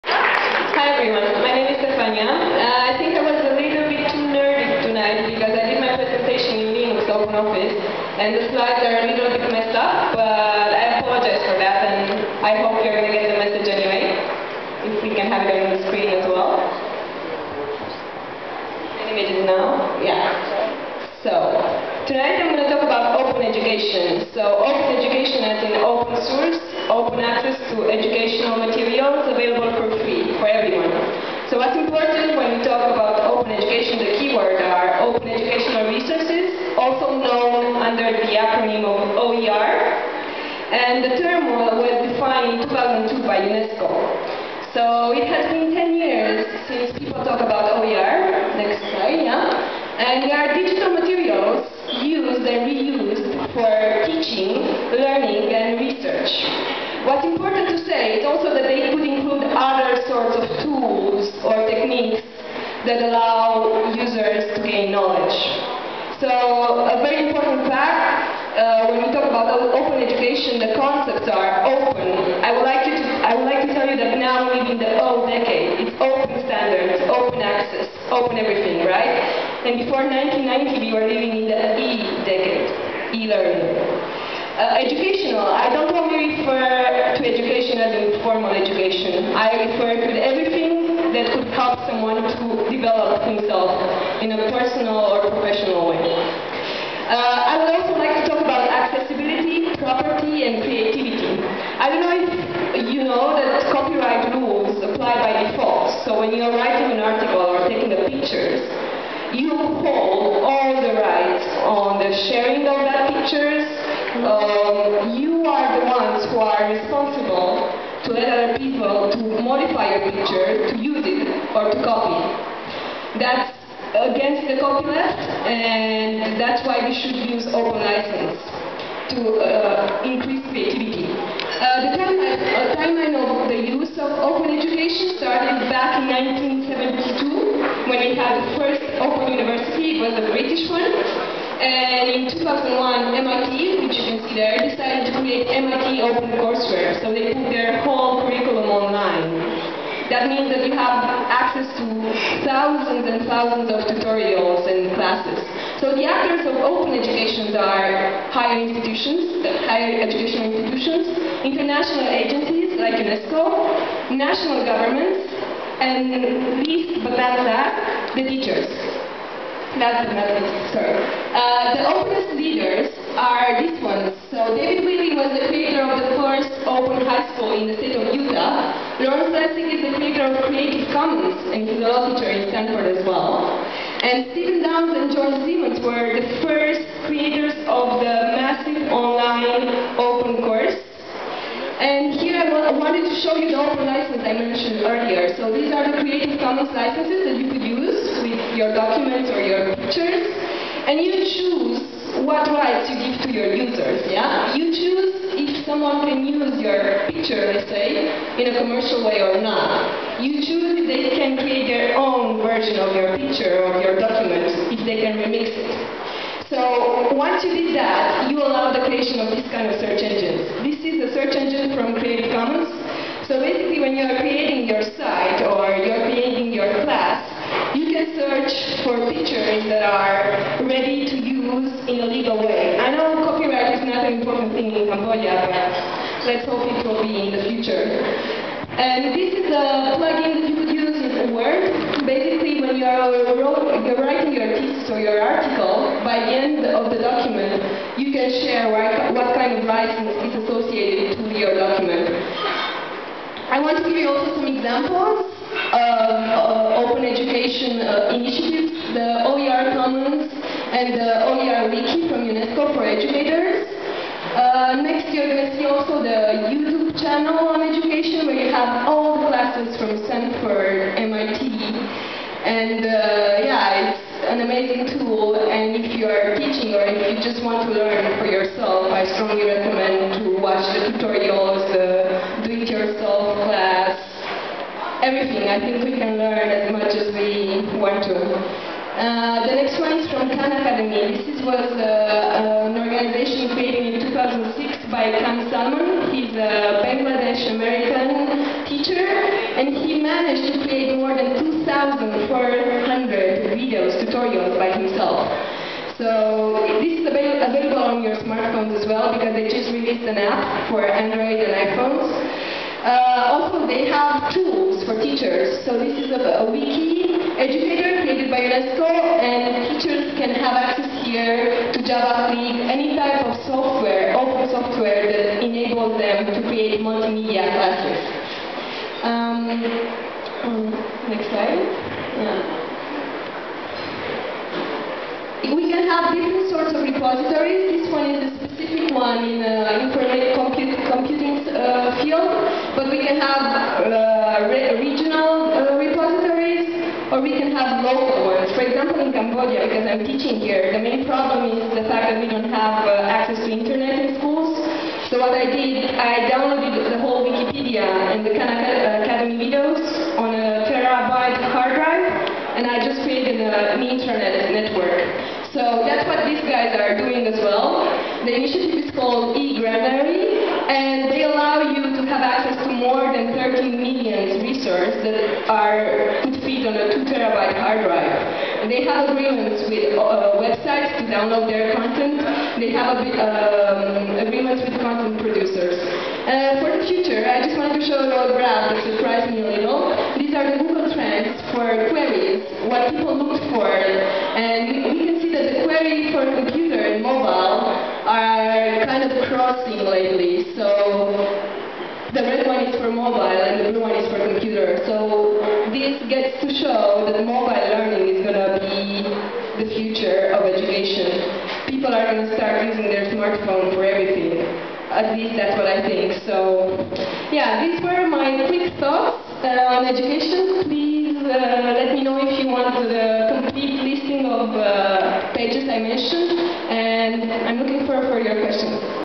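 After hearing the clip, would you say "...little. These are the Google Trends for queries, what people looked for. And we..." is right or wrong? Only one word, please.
right.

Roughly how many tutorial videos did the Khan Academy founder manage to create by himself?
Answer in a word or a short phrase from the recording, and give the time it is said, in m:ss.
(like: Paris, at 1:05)
2,400, at 5:01.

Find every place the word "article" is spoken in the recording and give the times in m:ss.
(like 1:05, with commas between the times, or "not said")
1:46, 4:05.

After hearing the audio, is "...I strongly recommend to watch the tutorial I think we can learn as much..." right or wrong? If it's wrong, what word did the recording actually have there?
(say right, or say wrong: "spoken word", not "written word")
right.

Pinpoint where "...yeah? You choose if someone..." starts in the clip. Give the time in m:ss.
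3:24.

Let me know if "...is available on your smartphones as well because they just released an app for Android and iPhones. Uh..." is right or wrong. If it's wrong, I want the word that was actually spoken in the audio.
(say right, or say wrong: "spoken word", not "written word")
right.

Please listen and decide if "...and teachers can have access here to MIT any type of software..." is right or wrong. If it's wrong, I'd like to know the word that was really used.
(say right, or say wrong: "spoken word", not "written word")
wrong: "Java", not "MIT".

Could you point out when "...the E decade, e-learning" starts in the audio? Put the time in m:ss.
1:21.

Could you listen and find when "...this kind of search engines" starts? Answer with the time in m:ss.
3:39.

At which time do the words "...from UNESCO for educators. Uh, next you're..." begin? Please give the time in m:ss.
4:22.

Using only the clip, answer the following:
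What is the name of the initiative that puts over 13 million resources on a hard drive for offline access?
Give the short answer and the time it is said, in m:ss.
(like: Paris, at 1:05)
eGranary, at 6:09.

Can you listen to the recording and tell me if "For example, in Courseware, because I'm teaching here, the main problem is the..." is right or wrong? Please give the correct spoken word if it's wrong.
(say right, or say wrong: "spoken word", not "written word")
wrong: "Cambodia", not "Courseware".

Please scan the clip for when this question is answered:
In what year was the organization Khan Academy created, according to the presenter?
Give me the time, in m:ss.
4:54.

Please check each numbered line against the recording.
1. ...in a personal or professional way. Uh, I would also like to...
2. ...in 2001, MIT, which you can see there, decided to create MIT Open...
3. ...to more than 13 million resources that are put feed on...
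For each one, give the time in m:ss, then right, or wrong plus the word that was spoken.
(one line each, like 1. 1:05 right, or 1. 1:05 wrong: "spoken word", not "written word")
1. 1:34 right
2. 2:22 right
3. 6:12 right.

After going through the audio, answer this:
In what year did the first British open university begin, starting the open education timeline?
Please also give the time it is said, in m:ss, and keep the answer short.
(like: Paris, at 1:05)
1972, at 2:16.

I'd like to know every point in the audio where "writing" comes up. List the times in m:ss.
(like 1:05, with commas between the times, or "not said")
1:46, 4:03.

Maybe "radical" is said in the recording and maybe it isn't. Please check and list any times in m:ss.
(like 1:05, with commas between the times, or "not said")
not said.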